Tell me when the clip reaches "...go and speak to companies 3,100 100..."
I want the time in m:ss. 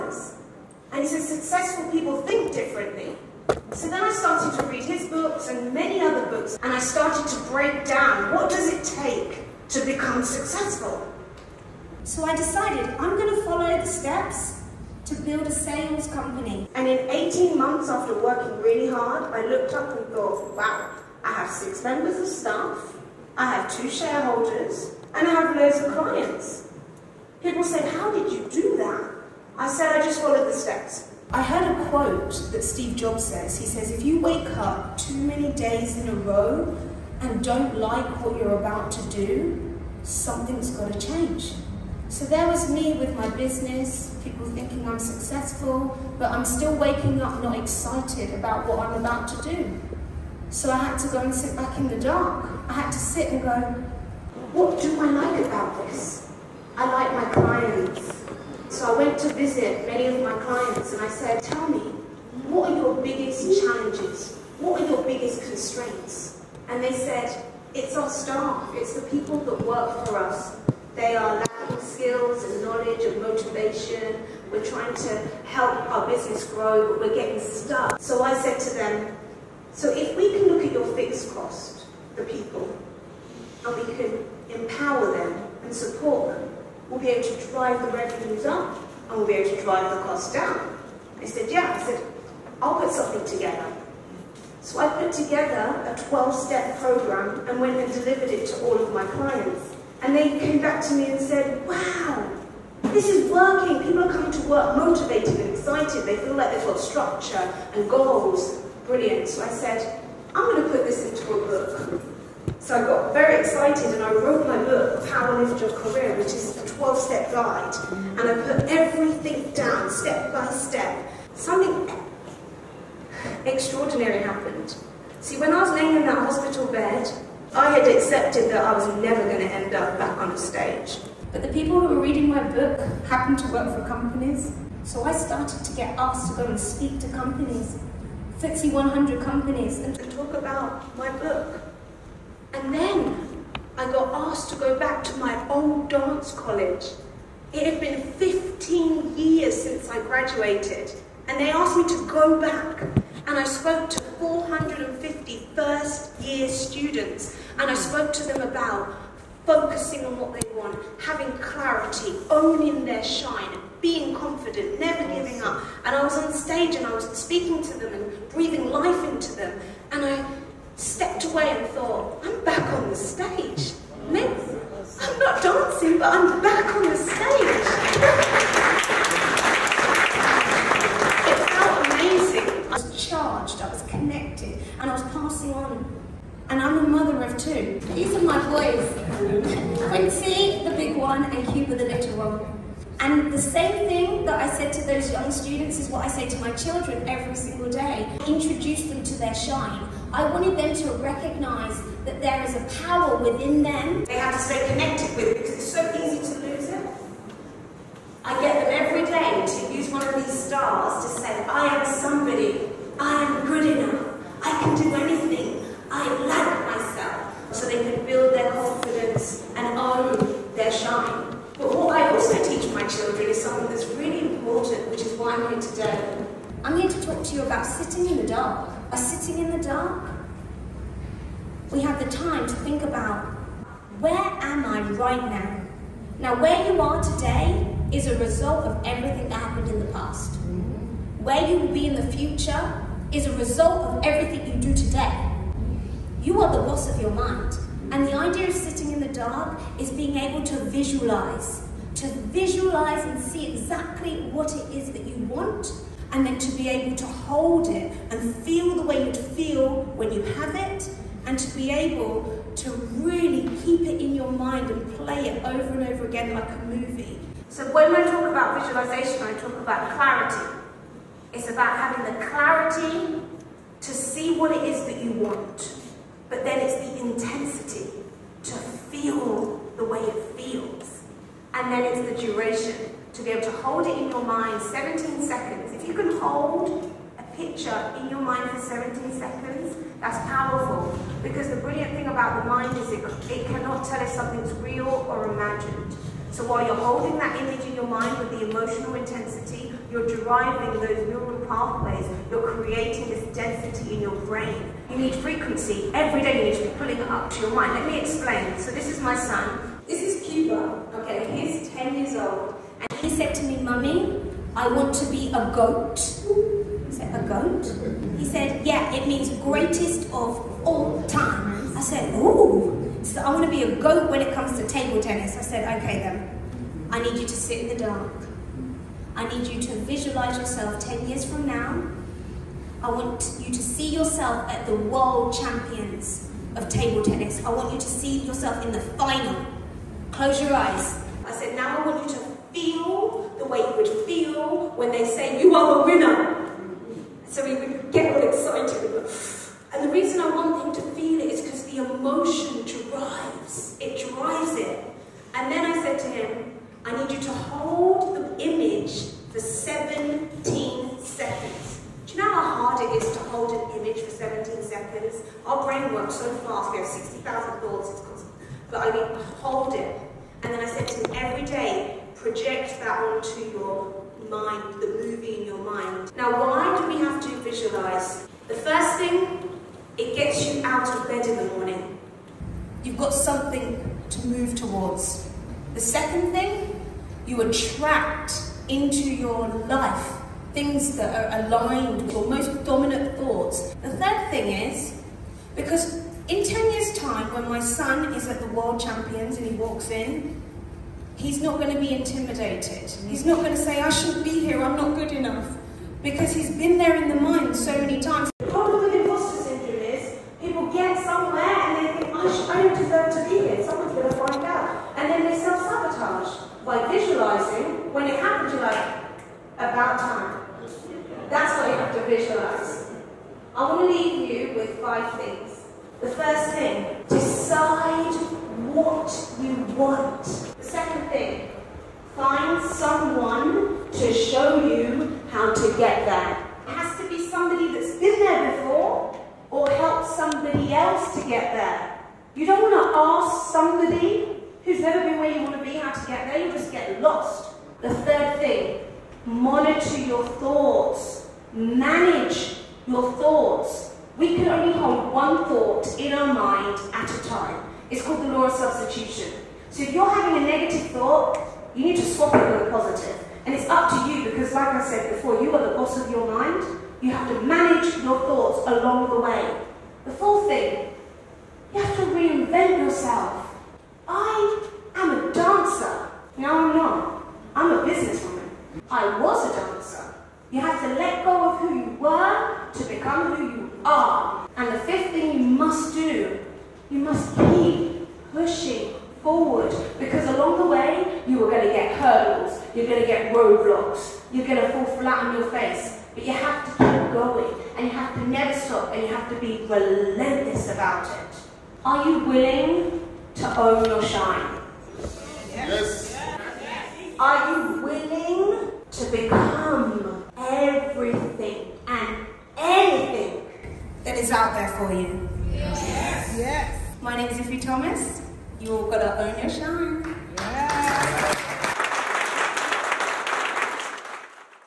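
2:16.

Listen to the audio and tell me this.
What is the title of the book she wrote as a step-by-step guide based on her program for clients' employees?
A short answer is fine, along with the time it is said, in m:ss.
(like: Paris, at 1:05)
Lift Your Career, at 1:55.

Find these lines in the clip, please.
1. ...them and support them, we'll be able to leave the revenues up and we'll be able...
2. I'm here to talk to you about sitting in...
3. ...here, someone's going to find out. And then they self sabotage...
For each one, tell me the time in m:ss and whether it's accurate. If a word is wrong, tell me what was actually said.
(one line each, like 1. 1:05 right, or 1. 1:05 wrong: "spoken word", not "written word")
1. 1:25 wrong: "drive", not "leave"
2. 3:46 right
3. 6:53 right.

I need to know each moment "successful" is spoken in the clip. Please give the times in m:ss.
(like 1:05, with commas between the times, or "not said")
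0:01, 0:10, 0:44.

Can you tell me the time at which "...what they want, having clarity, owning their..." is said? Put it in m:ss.
2:40.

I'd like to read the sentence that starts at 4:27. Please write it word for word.
So when I talk about visualization, I talk about clarity.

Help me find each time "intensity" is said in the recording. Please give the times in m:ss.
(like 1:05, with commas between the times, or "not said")
4:37, 4:58.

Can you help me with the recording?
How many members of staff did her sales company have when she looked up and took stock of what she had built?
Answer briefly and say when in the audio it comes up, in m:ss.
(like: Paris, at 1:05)
6, at 0:21.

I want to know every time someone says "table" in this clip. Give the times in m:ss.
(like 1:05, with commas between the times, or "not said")
5:24, 5:36.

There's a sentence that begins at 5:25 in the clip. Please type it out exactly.
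I said, okay then, I need you to sit in the dark.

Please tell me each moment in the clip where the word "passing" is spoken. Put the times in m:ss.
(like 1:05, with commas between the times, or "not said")
3:05.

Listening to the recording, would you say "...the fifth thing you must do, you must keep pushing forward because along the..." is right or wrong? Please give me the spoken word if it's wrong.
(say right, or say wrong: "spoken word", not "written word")
right.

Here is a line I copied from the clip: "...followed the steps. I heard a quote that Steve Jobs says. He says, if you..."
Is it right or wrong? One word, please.
right.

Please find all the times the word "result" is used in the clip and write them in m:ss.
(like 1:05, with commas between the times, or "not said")
3:58, 4:03.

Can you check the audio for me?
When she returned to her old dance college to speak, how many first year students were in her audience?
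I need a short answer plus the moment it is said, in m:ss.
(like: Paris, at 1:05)
450, at 2:34.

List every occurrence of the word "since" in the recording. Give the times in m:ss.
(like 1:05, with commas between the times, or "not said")
2:29.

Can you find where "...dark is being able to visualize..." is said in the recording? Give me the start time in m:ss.
4:09.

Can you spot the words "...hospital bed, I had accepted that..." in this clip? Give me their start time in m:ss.
2:06.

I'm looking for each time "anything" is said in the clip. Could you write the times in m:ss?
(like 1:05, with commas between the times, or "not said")
3:34, 8:32.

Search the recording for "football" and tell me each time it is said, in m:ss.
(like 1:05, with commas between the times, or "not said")
not said.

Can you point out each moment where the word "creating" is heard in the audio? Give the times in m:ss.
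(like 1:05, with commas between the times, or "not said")
5:02.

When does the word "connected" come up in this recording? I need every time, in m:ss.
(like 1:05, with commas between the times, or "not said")
3:03, 3:24.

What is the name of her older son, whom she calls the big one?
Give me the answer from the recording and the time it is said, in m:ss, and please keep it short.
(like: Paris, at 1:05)
Quincy, at 3:09.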